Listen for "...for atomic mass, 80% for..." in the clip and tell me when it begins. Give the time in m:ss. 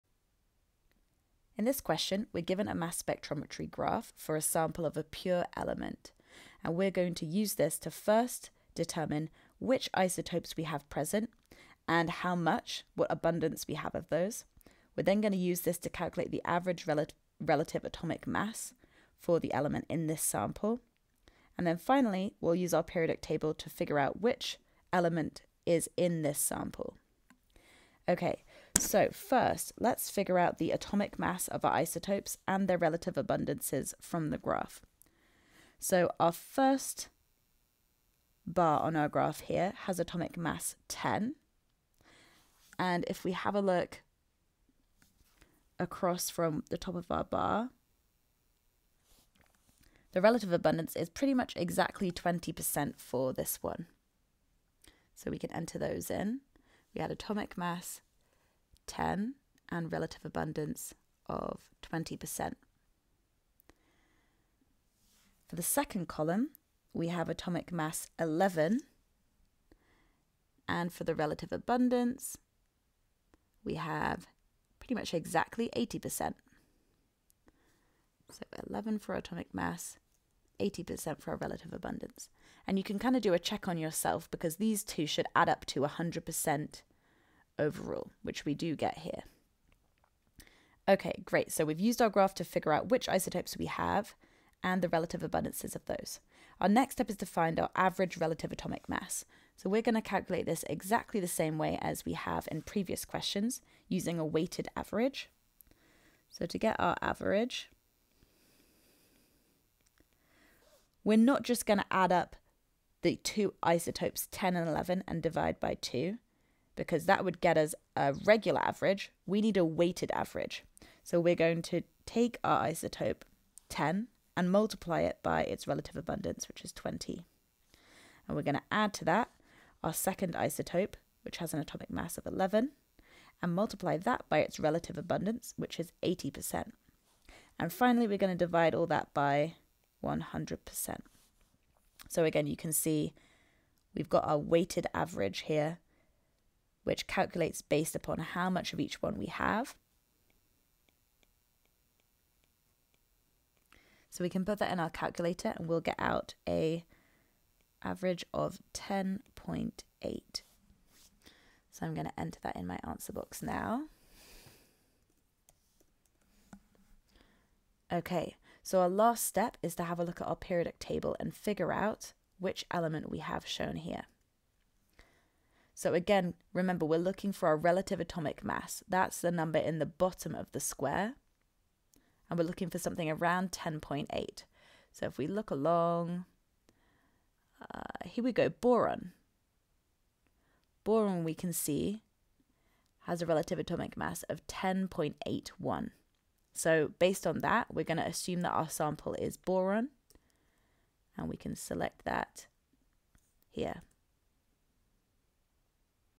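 1:18.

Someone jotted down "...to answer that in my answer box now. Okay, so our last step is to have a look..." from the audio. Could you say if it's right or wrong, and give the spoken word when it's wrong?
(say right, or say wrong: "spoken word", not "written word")
wrong: "enter", not "answer".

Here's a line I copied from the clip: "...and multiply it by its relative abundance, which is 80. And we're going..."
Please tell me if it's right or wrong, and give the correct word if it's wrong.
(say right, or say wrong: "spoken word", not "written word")
wrong: "20", not "80".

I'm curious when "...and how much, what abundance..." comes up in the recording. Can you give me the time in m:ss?
0:11.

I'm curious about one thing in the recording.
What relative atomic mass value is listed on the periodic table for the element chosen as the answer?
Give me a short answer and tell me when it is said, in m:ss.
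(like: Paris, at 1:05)
10.81, at 3:14.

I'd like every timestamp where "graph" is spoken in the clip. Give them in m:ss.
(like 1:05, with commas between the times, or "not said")
0:03, 0:34, 0:39, 1:32.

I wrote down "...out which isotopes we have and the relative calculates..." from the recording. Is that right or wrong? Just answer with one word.
wrong.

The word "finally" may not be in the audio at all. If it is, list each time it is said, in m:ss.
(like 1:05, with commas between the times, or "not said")
0:21, 2:17.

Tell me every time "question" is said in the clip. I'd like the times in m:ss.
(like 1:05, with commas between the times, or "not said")
0:01, 1:43.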